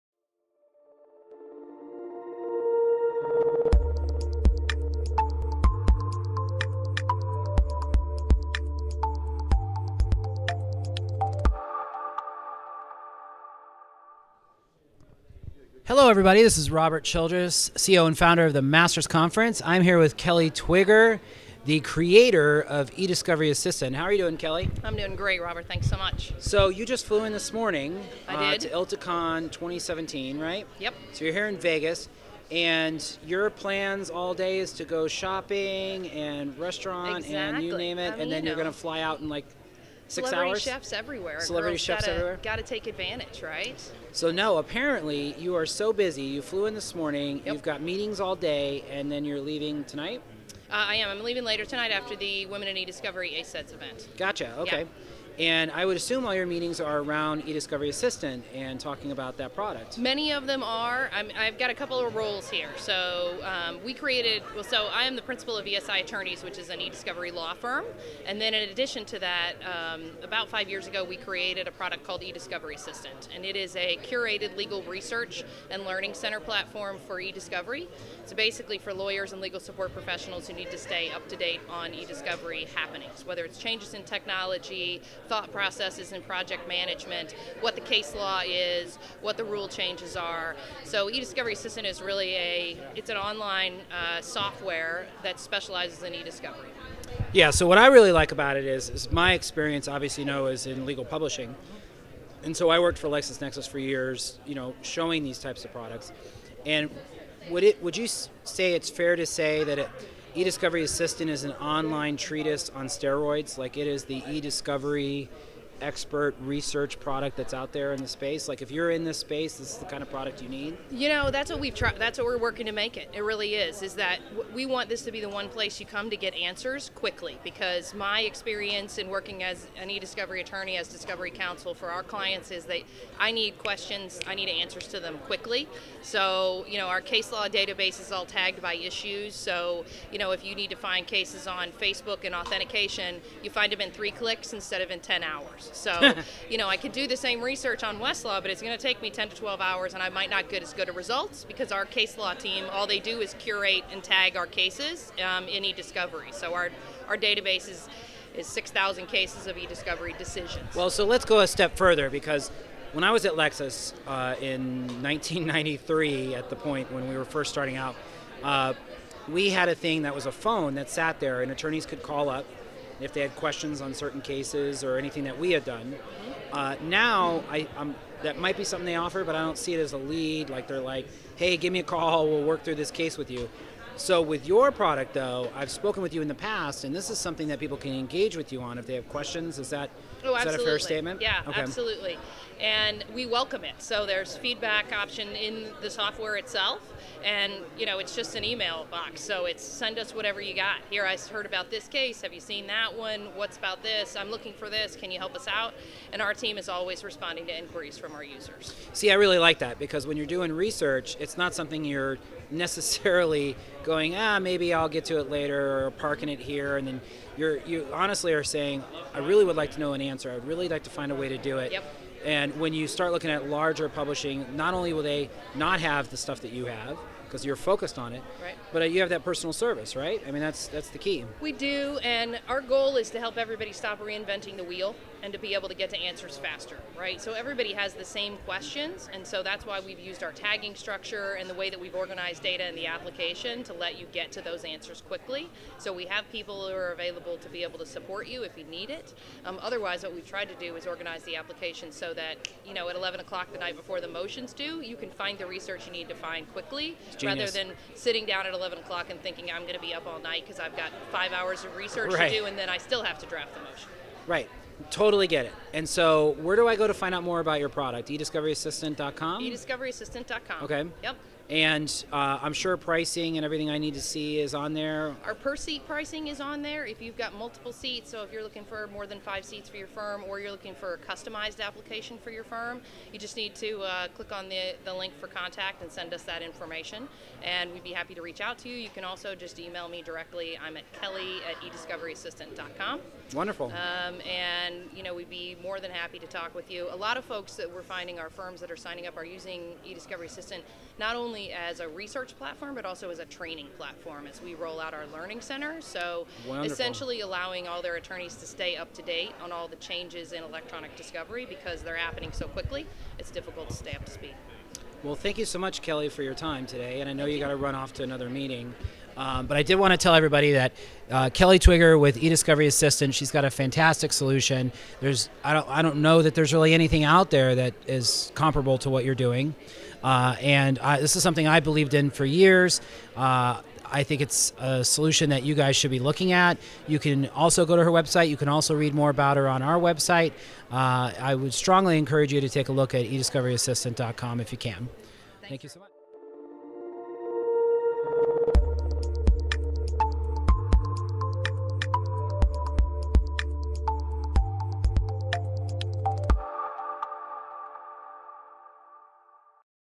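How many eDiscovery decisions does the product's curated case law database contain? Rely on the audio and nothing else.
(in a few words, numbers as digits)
6,000.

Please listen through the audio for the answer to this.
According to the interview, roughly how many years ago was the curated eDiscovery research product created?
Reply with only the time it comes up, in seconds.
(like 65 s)
70 s.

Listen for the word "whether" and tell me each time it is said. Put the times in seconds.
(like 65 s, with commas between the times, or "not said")
83 s.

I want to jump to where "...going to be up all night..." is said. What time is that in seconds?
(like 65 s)
259 s.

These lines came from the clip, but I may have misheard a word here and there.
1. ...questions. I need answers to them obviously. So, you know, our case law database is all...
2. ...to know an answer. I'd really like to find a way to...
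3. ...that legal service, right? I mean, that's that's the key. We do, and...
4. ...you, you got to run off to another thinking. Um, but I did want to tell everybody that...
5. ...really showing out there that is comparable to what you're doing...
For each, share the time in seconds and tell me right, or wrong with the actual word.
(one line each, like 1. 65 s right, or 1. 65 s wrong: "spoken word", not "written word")
1. 133 s wrong: "quickly", not "obviously"
2. 219 s right
3. 229 s wrong: "personal", not "legal"
4. 317 s wrong: "meeting", not "thinking"
5. 326 s wrong: "anything", not "showing".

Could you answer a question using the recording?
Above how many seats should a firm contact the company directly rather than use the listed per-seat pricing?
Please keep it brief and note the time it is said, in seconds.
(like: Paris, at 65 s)
5, at 279 s.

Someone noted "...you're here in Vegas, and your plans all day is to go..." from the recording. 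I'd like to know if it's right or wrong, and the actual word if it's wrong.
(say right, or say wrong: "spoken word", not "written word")
right.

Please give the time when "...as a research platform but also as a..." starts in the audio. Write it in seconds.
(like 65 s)
301 s.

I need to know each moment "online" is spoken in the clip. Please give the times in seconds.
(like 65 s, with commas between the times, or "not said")
93 s, 111 s.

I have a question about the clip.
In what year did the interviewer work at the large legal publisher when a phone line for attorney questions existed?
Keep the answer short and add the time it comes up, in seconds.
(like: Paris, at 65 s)
1993, at 165 s.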